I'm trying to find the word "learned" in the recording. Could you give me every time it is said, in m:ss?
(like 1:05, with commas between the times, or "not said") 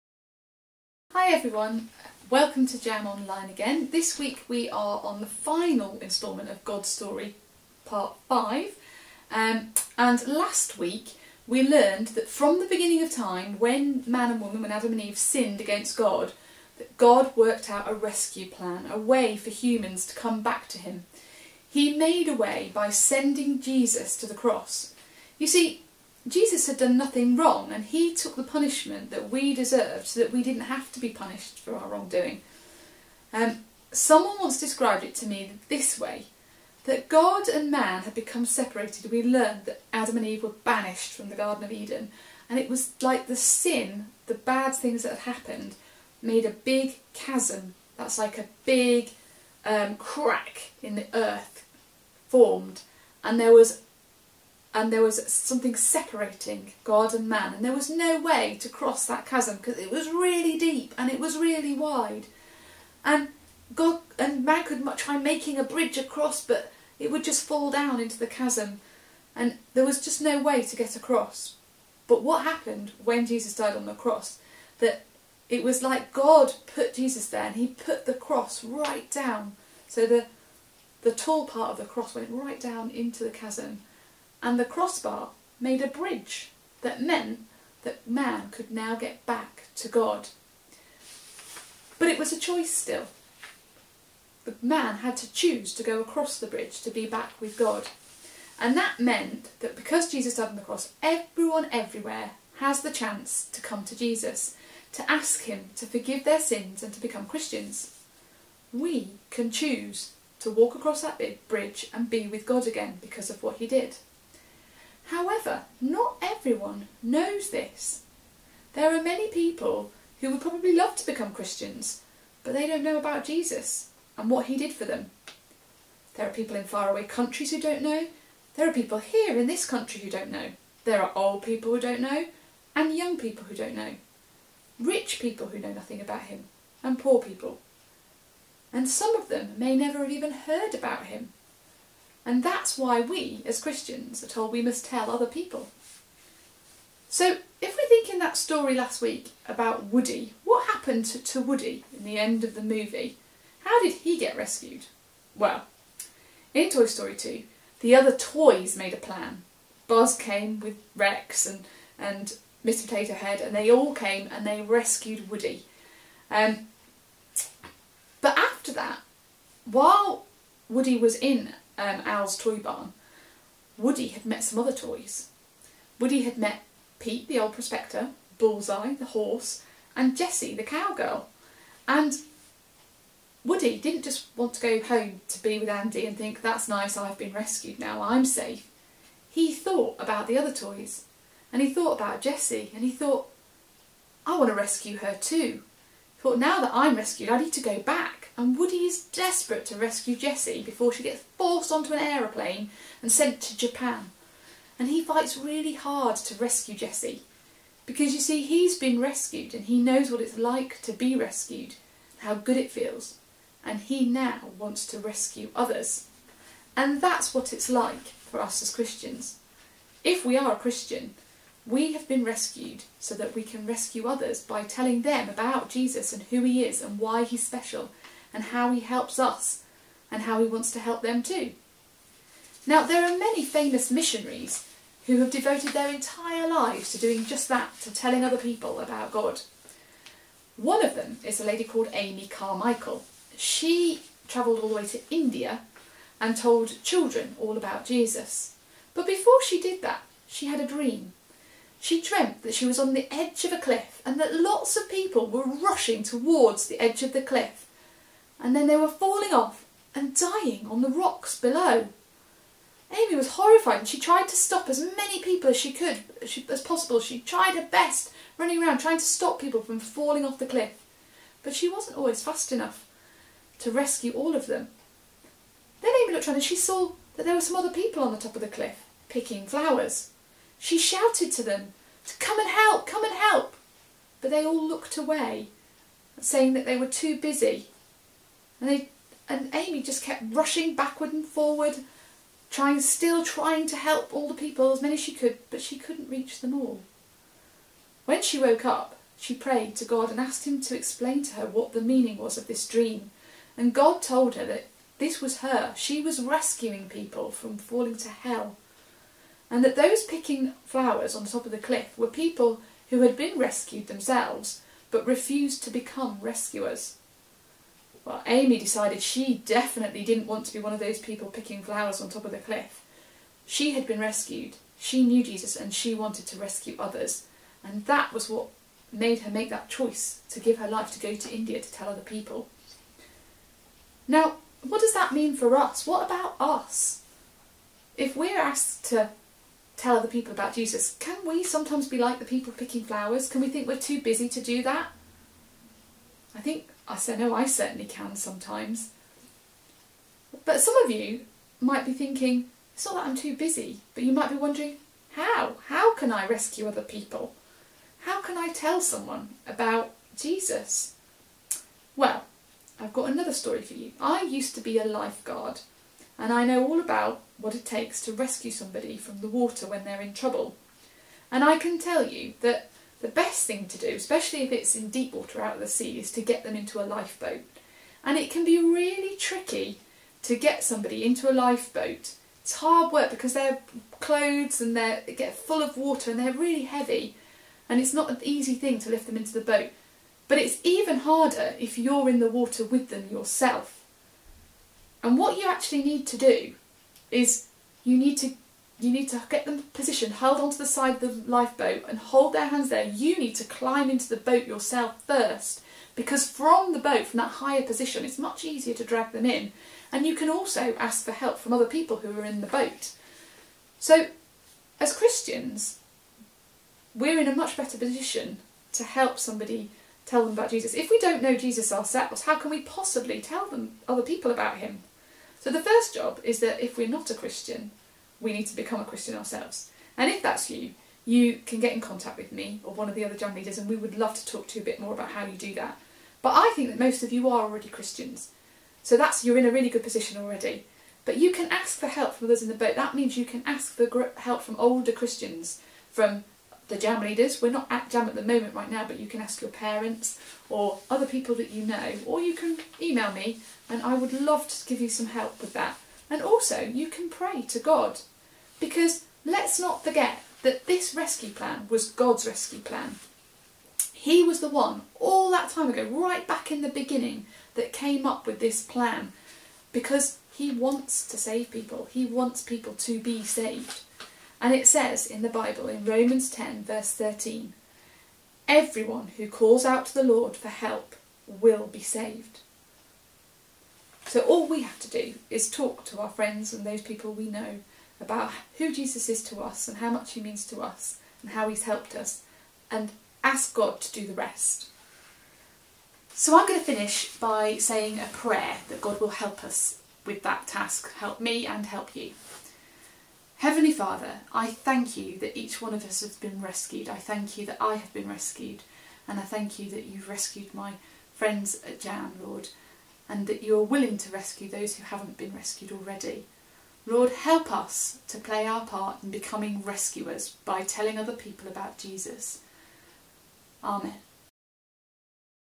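0:11, 0:39.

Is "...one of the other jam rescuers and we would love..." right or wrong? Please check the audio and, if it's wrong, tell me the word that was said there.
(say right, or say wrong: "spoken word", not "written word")
wrong: "leaders", not "rescuers".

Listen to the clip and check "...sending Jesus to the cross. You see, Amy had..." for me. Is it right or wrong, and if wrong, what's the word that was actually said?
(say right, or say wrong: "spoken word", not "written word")
wrong: "Jesus", not "Amy".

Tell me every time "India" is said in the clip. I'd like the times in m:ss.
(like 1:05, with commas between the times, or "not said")
4:05, 5:31.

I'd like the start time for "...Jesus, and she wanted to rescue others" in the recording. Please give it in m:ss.
5:25.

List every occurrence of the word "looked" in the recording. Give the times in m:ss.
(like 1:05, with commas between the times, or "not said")
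4:36, 4:44.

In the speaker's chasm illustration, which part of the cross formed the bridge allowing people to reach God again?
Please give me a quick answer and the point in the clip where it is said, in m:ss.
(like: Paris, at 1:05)
The crossbar, at 1:24.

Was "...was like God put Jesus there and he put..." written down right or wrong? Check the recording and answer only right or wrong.
right.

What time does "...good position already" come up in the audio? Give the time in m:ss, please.
7:19.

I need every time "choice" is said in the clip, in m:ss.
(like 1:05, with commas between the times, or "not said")
1:32, 5:29.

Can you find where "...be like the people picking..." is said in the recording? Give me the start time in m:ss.
5:41.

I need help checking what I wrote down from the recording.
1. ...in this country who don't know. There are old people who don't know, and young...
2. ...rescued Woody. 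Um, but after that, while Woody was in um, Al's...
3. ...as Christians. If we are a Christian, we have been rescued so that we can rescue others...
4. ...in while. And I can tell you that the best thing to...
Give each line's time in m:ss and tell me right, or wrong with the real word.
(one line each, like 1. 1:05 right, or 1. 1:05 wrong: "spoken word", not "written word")
1. 2:09 right
2. 2:44 right
3. 3:38 right
4. 6:10 wrong: "trouble", not "while".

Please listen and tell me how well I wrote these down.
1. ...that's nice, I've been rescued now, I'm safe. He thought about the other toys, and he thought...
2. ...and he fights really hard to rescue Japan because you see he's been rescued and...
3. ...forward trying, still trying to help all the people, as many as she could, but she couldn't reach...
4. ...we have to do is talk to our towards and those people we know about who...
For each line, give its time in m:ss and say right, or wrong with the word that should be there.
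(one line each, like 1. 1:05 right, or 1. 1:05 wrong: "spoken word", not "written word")
1. 3:06 right
2. 3:24 wrong: "Jessie", not "Japan"
3. 4:51 right
4. 8:04 wrong: "friends", not "towards".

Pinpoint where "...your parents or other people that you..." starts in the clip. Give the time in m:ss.
7:29.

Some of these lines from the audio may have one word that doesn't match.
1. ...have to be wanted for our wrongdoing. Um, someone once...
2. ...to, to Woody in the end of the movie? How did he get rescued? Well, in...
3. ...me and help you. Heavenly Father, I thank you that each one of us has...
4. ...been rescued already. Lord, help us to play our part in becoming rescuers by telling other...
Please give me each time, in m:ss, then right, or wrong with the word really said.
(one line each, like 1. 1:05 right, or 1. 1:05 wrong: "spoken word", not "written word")
1. 0:30 wrong: "punished", not "wanted"
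2. 2:31 right
3. 8:21 right
4. 8:35 right.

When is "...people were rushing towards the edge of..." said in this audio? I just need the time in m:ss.
4:14.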